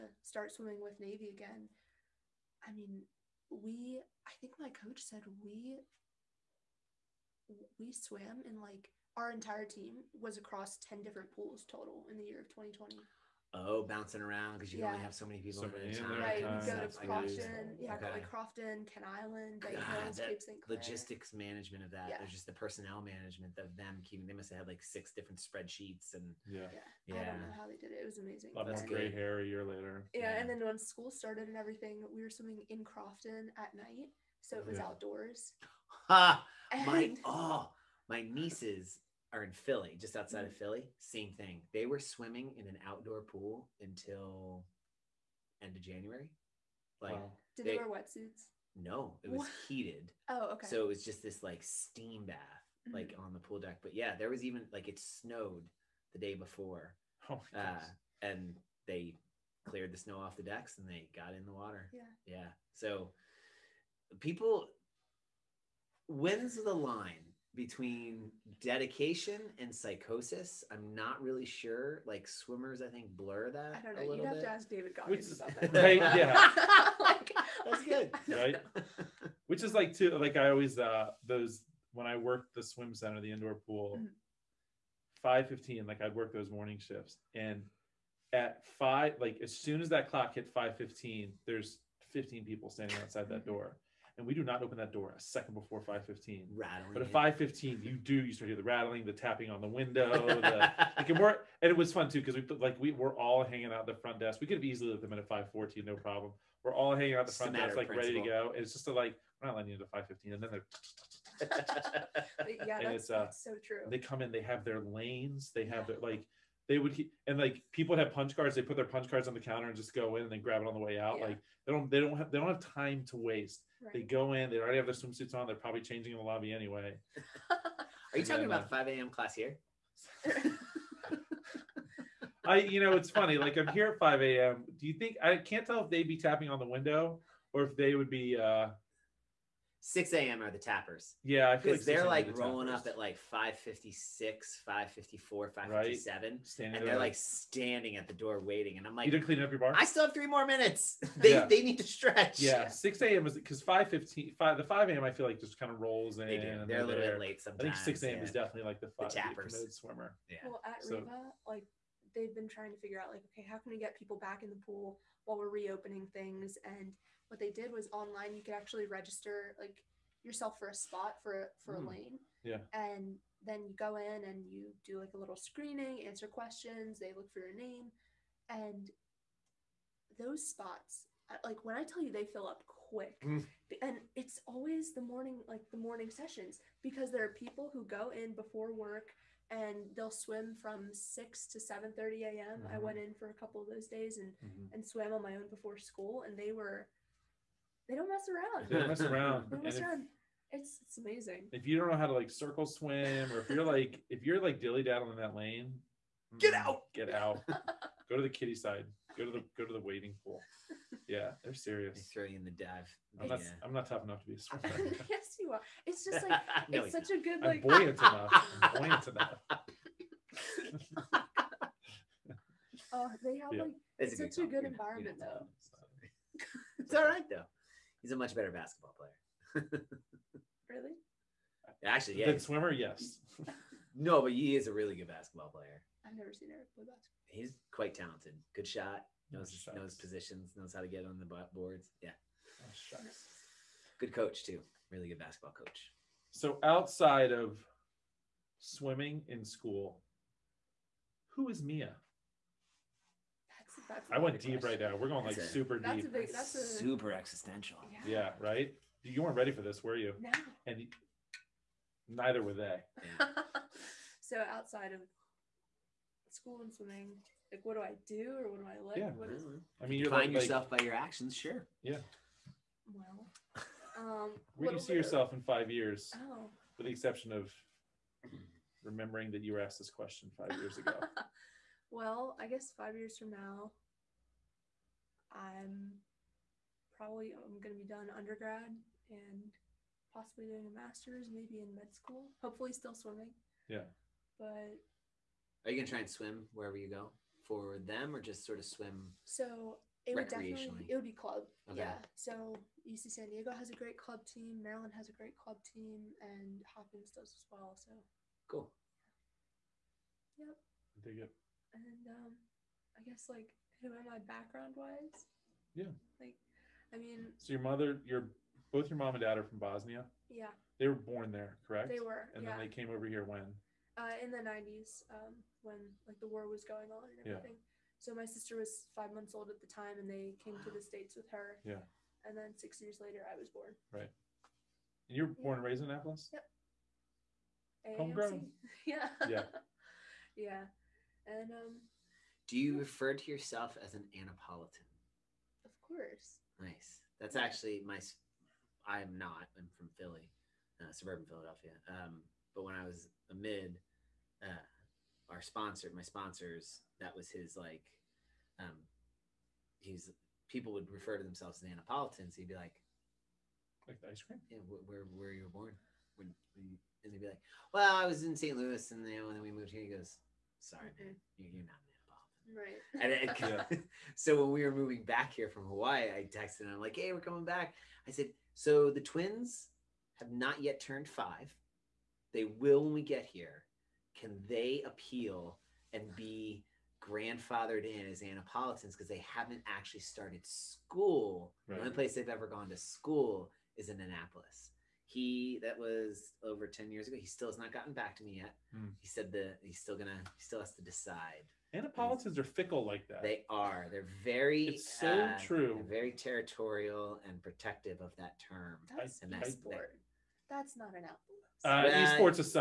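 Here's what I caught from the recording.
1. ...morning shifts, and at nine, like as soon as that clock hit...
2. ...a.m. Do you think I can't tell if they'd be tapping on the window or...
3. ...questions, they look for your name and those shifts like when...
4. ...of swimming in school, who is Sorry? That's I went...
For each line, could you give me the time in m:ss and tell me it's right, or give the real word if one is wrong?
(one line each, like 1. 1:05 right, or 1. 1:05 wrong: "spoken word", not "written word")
1. 1:26 wrong: "five", not "nine"
2. 2:14 right
3. 2:56 wrong: "spots", not "shifts"
4. 4:07 wrong: "Mia", not "Sorry".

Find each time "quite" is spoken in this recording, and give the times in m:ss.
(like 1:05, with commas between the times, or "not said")
3:57.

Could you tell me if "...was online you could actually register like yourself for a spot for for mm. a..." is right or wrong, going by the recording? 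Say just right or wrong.
right.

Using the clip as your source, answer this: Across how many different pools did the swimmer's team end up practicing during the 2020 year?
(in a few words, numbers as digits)
10.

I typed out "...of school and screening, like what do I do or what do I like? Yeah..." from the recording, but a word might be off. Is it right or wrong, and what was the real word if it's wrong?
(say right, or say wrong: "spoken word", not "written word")
wrong: "swimming", not "screening".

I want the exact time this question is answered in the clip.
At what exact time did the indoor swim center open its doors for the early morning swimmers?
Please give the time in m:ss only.
1:34.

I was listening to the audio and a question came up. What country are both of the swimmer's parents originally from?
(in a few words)
Bosnia.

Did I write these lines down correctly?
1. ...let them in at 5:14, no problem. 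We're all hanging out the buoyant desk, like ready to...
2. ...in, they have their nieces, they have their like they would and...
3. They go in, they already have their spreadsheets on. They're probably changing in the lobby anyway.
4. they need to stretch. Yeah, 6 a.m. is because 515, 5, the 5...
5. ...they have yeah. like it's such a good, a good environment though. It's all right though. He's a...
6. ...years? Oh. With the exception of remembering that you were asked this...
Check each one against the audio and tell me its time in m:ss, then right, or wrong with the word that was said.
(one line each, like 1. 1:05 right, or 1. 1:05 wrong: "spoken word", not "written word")
1. 1:44 wrong: "front", not "buoyant"
2. 1:54 wrong: "lanes", not "nieces"
3. 2:03 wrong: "swimsuits", not "spreadsheets"
4. 2:31 right
5. 3:43 right
6. 4:35 right.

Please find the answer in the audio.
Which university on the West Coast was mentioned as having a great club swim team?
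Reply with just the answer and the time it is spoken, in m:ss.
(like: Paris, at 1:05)
UC San Diego, at 5:02.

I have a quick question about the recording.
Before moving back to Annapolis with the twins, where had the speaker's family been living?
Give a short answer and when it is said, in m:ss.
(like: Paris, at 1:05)
Hawaii, at 6:15.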